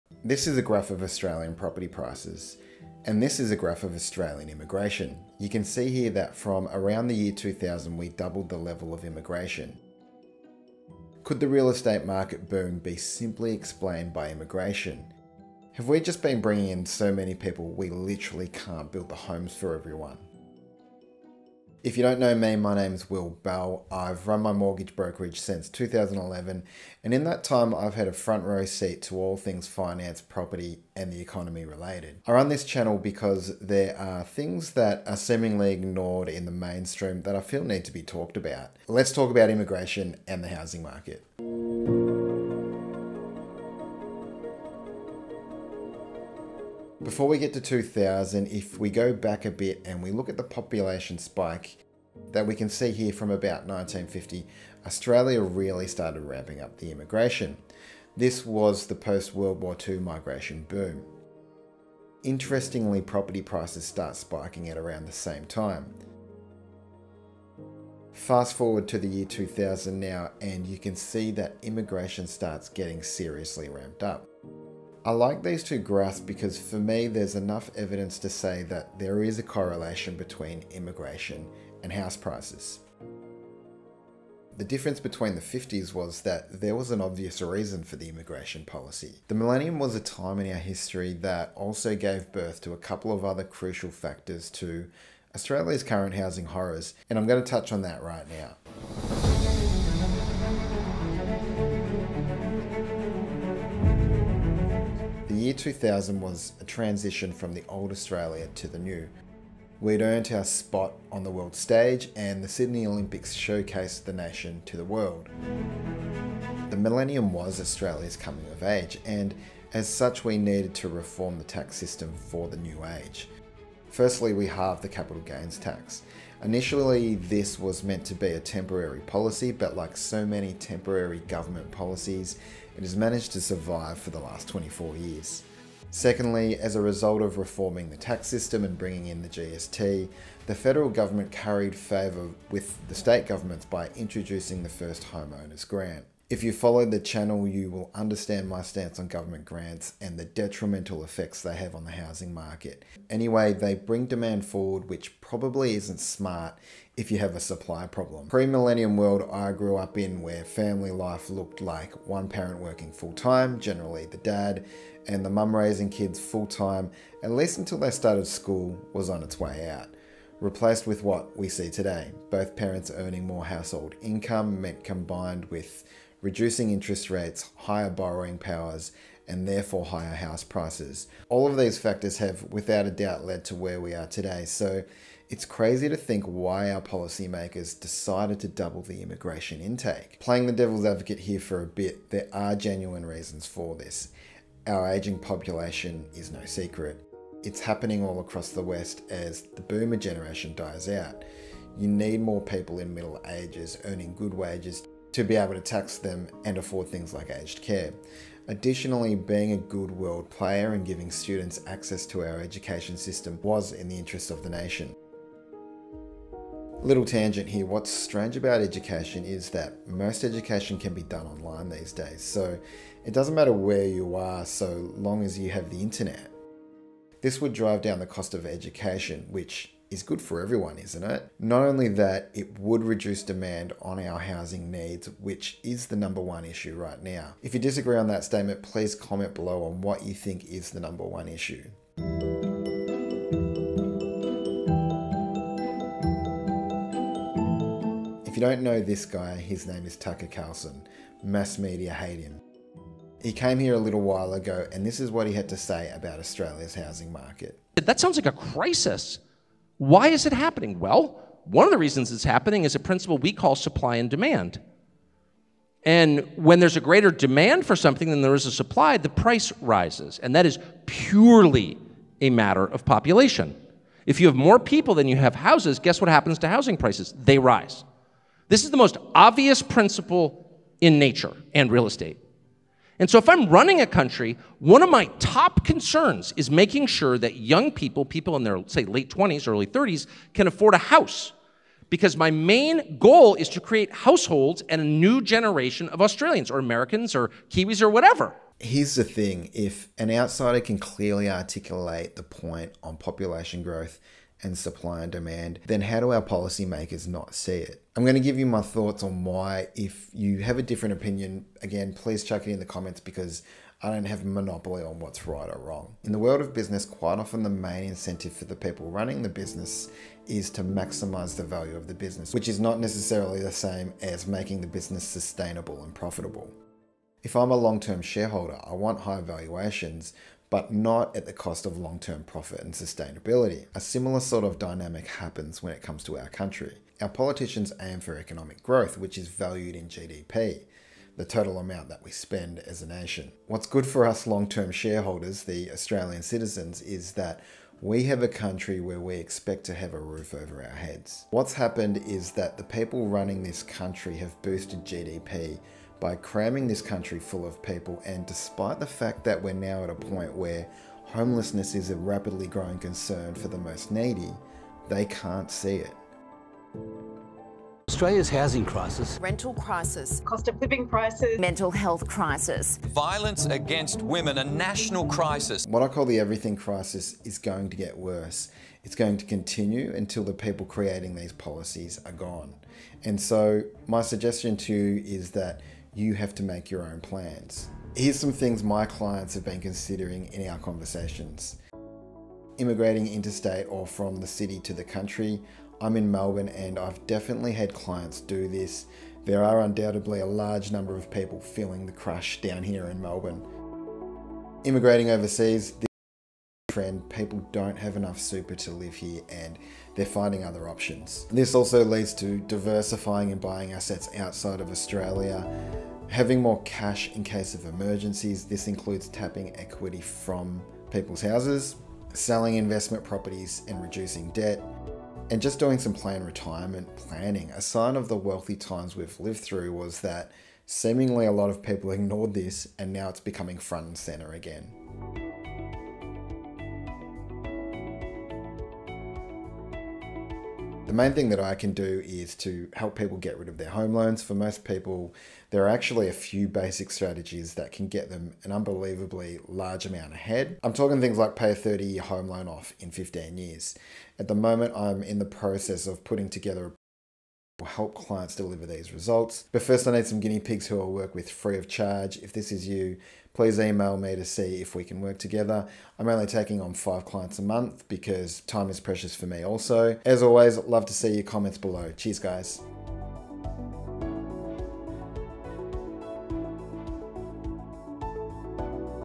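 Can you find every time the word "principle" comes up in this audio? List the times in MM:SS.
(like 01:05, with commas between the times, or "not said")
04:22, 04:39.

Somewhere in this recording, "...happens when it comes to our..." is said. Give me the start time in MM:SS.
05:35.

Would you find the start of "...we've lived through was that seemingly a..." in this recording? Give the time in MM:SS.
07:08.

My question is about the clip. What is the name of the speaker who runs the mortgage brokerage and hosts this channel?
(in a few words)
Will Bell.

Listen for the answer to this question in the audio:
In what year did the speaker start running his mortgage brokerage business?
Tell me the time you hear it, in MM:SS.
00:25.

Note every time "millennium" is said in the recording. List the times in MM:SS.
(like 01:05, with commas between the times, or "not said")
01:29, 01:56, 02:38.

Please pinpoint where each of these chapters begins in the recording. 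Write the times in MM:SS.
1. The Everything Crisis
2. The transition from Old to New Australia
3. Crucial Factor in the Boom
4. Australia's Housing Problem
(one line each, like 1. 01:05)
1. 06:07
2. 01:42
3. 00:45
4. 04:07.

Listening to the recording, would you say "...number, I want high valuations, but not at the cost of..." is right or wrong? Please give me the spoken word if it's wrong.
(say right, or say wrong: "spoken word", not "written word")
wrong: "shareholder", not "number".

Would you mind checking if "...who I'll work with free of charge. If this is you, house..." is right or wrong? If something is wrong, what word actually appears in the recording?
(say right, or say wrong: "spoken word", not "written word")
wrong: "please", not "house".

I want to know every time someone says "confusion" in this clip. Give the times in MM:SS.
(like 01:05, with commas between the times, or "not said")
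not said.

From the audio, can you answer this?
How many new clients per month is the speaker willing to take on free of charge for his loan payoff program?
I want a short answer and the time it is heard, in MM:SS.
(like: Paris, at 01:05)
5, at 07:46.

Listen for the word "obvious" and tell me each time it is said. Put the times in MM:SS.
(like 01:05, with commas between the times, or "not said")
01:27, 04:39.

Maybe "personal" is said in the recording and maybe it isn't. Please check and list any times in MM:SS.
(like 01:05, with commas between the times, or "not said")
not said.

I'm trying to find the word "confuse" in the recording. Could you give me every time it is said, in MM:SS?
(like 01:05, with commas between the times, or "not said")
not said.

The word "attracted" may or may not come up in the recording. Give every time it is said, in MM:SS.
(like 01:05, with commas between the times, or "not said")
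not said.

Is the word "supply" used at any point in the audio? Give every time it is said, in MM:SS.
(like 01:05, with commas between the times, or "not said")
02:37, 04:23, 04:28, 05:04.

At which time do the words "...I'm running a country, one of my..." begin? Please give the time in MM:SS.
04:43.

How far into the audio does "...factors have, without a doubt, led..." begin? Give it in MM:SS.
03:01.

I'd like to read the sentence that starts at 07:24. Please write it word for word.
For most people, there are actually a few basic strategies that can get them an unbelievably large amount ahead.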